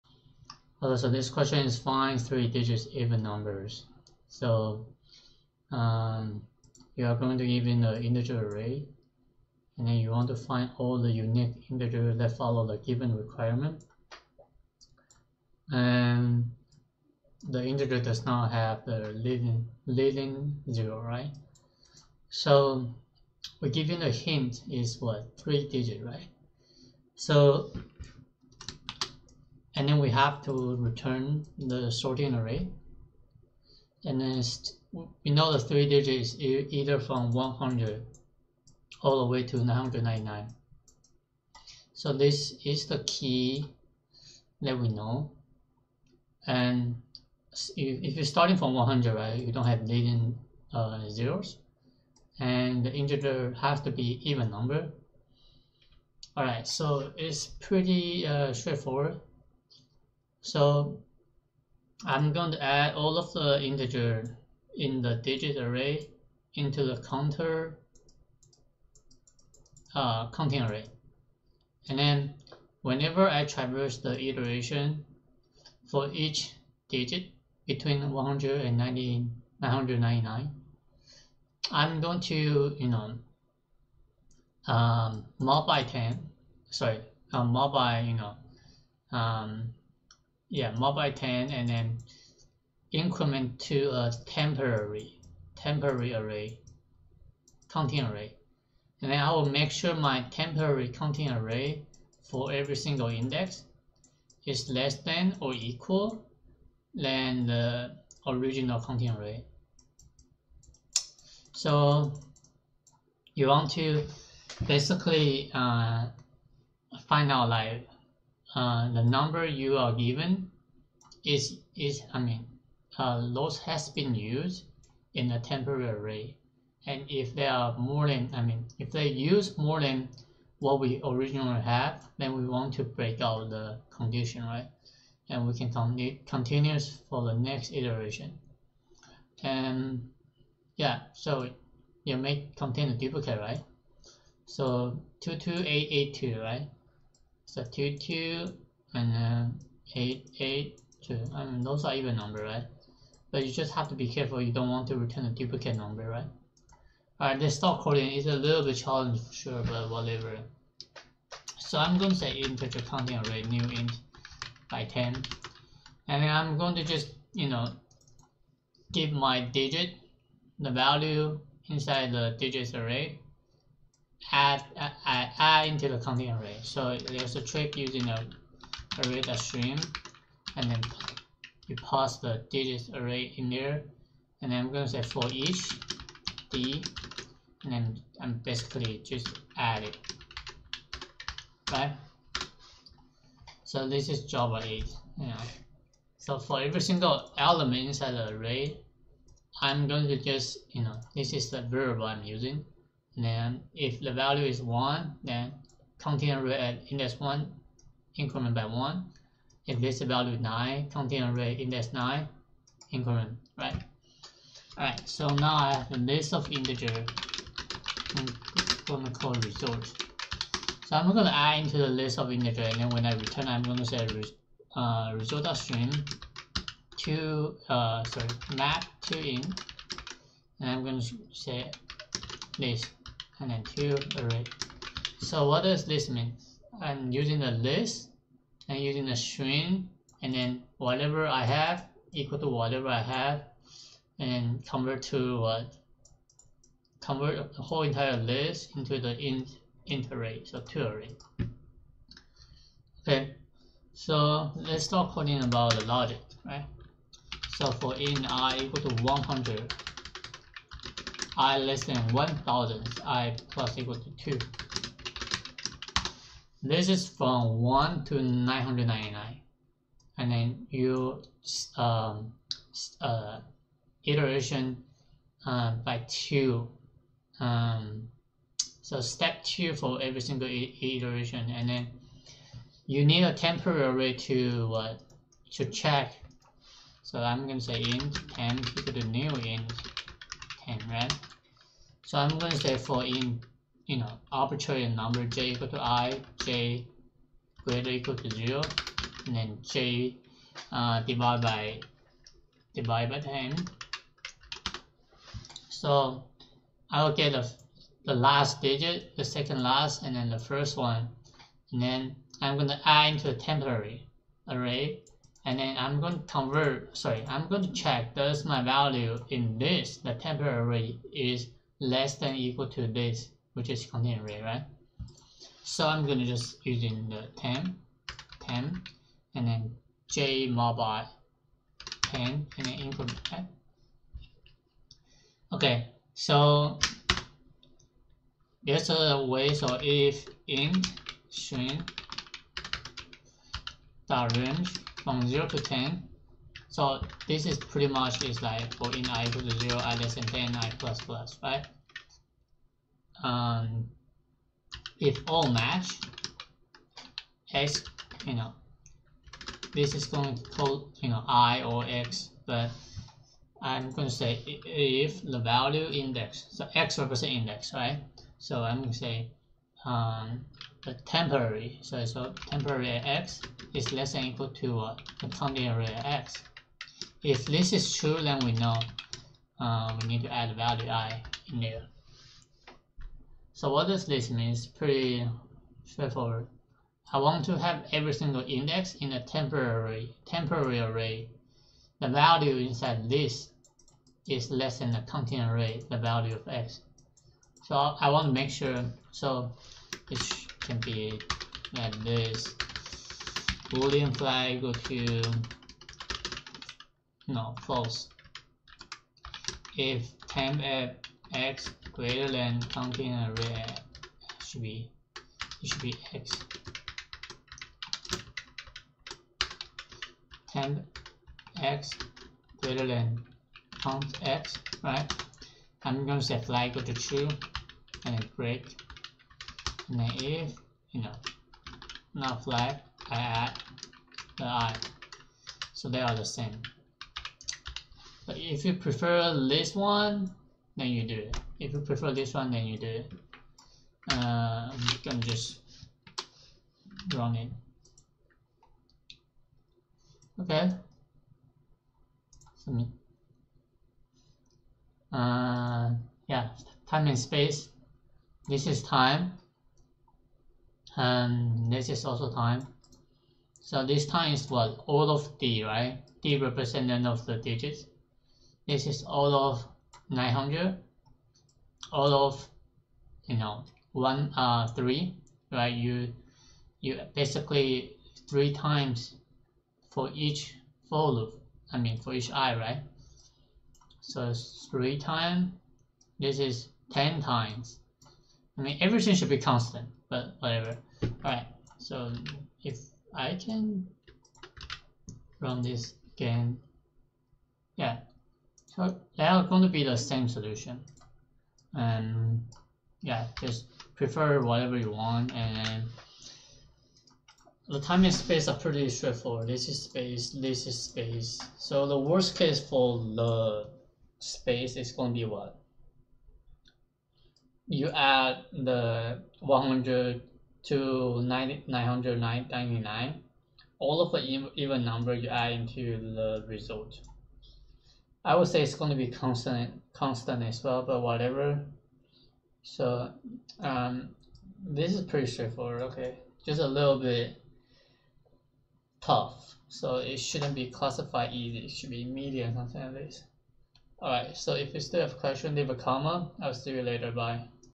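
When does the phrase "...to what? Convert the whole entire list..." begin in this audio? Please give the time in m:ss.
4:05.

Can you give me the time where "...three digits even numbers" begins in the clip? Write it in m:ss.
0:02.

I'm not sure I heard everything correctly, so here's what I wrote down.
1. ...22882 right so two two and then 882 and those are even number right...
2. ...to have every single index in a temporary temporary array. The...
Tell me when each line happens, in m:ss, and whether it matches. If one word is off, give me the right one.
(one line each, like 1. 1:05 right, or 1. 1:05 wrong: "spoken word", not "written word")
1. 2:25 right
2. 6:27 right.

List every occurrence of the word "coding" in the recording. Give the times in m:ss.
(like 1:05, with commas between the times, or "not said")
2:37, 4:15.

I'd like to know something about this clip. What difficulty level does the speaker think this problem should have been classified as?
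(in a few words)
medium.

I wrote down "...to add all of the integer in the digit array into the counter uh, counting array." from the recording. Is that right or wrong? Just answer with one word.
right.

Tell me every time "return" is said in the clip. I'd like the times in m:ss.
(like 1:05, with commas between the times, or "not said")
0:30, 2:34, 3:43.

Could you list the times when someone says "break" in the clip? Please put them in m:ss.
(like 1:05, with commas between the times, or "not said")
2:12, 7:08.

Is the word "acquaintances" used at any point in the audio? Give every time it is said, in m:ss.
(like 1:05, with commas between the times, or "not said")
not said.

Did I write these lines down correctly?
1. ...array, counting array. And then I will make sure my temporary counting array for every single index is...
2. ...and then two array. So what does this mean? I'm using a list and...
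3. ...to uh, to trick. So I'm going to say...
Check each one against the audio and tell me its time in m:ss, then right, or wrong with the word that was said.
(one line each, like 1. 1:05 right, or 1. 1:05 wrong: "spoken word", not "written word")
1. 1:36 right
2. 3:53 right
3. 4:44 wrong: "check", not "trick".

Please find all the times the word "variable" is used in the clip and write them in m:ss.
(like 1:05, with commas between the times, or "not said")
3:21.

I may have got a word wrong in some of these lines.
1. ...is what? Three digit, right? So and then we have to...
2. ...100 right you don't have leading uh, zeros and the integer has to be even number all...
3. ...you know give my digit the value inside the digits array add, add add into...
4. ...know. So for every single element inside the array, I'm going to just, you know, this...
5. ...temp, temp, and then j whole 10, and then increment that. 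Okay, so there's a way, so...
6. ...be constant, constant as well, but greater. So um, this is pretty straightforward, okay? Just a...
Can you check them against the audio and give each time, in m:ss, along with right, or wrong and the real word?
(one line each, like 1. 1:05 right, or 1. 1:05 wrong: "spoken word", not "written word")
1. 0:24 right
2. 0:48 right
3. 2:47 right
4. 3:15 right
5. 5:27 wrong: "mobile", not "whole"
6. 8:48 wrong: "whatever", not "greater".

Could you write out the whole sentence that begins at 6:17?
If this is true, then we know uh, we need to add value i in there.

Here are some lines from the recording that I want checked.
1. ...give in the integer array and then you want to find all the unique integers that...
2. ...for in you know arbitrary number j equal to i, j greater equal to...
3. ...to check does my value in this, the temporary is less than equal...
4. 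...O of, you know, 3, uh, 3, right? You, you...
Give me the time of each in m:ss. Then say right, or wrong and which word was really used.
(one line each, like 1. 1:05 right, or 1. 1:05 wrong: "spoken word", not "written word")
1. 0:07 right
2. 4:52 right
3. 5:17 right
4. 7:51 wrong: "1", not "3".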